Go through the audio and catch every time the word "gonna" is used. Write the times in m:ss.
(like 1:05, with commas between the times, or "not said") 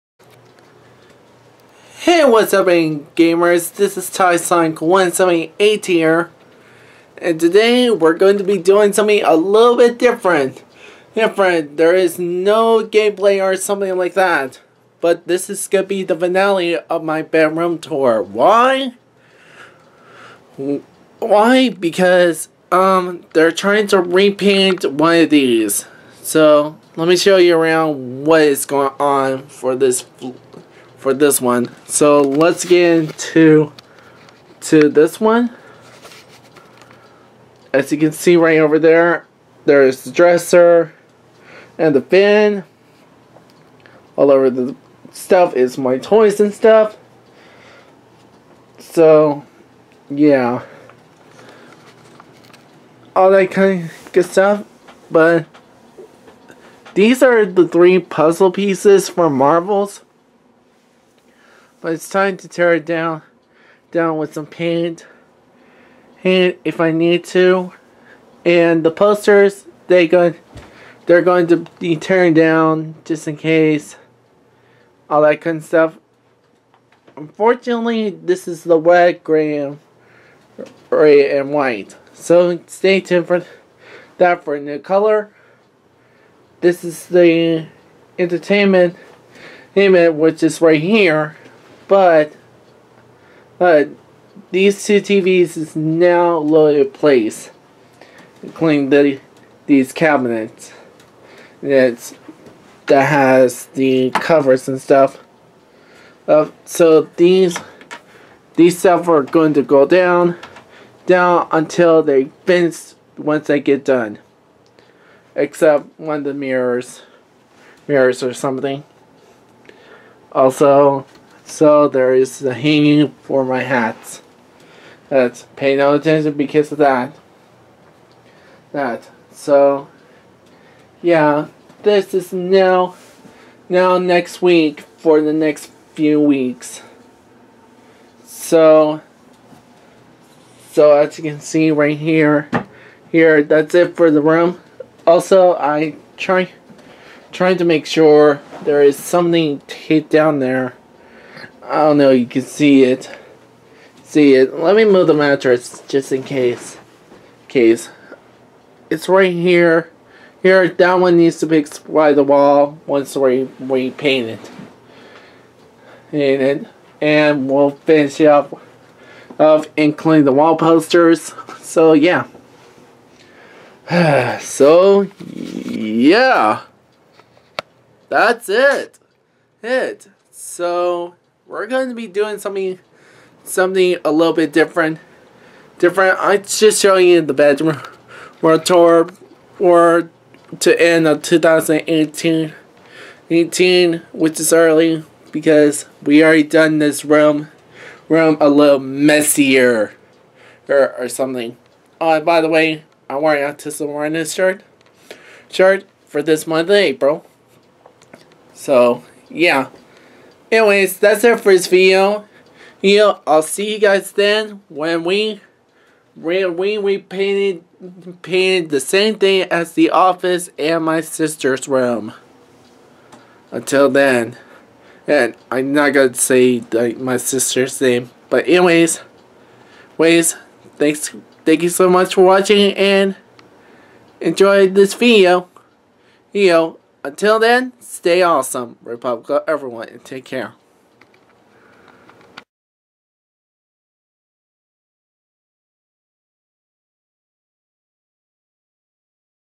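0:15, 3:45.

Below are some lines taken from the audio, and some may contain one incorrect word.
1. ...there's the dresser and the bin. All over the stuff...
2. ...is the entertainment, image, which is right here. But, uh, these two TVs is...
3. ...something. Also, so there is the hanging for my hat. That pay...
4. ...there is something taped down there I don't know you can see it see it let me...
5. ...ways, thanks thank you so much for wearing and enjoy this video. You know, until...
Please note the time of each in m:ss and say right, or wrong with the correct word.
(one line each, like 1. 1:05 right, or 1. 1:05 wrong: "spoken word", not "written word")
1. 0:39 right
2. 1:26 right
3. 1:58 right
4. 2:28 right
5. 3:49 wrong: "watching", not "wearing".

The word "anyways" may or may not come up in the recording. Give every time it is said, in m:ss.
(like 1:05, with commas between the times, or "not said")
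3:30, 3:48.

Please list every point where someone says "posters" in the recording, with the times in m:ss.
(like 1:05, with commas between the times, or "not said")
1:08, 2:50.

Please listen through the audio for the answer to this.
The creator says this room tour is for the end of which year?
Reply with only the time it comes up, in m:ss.
3:11.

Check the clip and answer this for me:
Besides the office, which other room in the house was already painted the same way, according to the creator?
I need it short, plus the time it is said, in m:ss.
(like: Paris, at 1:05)
sister's room, at 3:40.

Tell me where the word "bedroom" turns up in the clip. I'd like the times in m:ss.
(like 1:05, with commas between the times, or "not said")
0:17, 3:07.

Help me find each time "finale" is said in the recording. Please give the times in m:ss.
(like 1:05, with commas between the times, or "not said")
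0:16.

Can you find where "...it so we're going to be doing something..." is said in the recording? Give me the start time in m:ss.
2:59.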